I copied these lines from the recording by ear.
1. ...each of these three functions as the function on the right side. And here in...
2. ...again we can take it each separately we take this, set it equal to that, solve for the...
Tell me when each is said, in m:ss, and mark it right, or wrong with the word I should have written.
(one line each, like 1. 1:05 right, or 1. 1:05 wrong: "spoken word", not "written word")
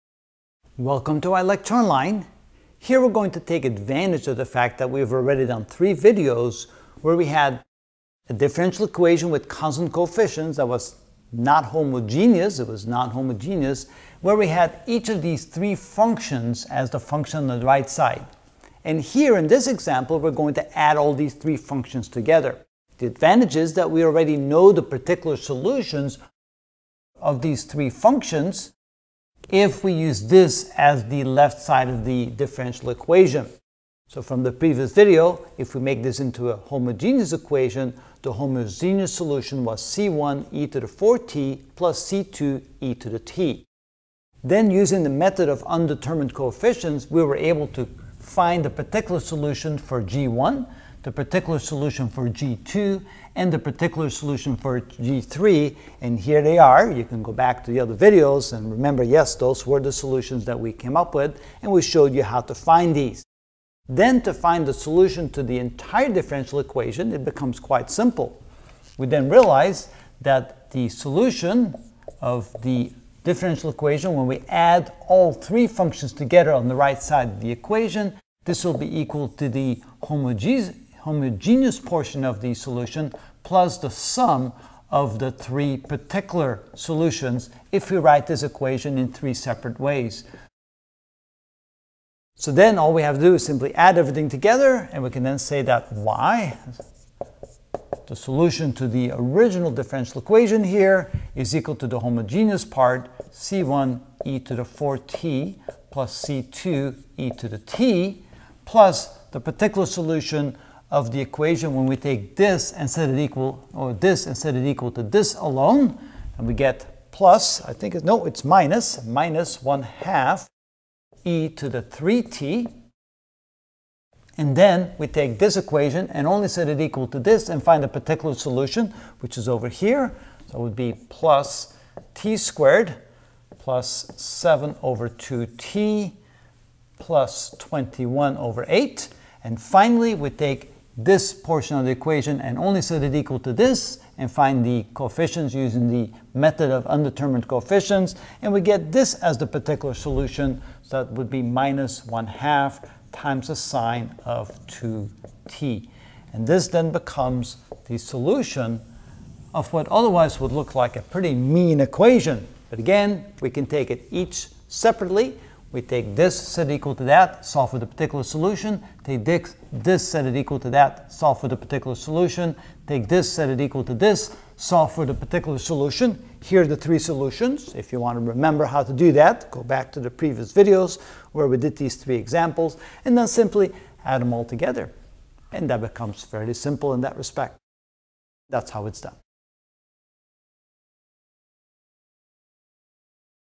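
1. 0:14 right
2. 2:42 right.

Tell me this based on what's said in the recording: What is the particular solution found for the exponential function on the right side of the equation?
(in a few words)
-1/2 e^(3t).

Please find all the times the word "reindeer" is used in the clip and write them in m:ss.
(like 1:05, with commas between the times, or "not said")
not said.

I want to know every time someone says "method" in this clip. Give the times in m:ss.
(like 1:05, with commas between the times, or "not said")
0:45, 2:26.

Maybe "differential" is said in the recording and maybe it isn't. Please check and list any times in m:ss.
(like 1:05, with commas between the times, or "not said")
0:08, 0:32, 1:06, 1:13, 1:39.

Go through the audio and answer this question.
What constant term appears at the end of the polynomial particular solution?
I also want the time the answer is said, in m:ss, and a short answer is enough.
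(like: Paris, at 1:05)
21/8, at 2:17.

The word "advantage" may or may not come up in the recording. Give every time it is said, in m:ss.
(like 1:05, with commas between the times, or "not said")
0:03, 0:23.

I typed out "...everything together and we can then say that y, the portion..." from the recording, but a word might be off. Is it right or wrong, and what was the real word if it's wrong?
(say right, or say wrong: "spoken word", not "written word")
wrong: "solution", not "portion".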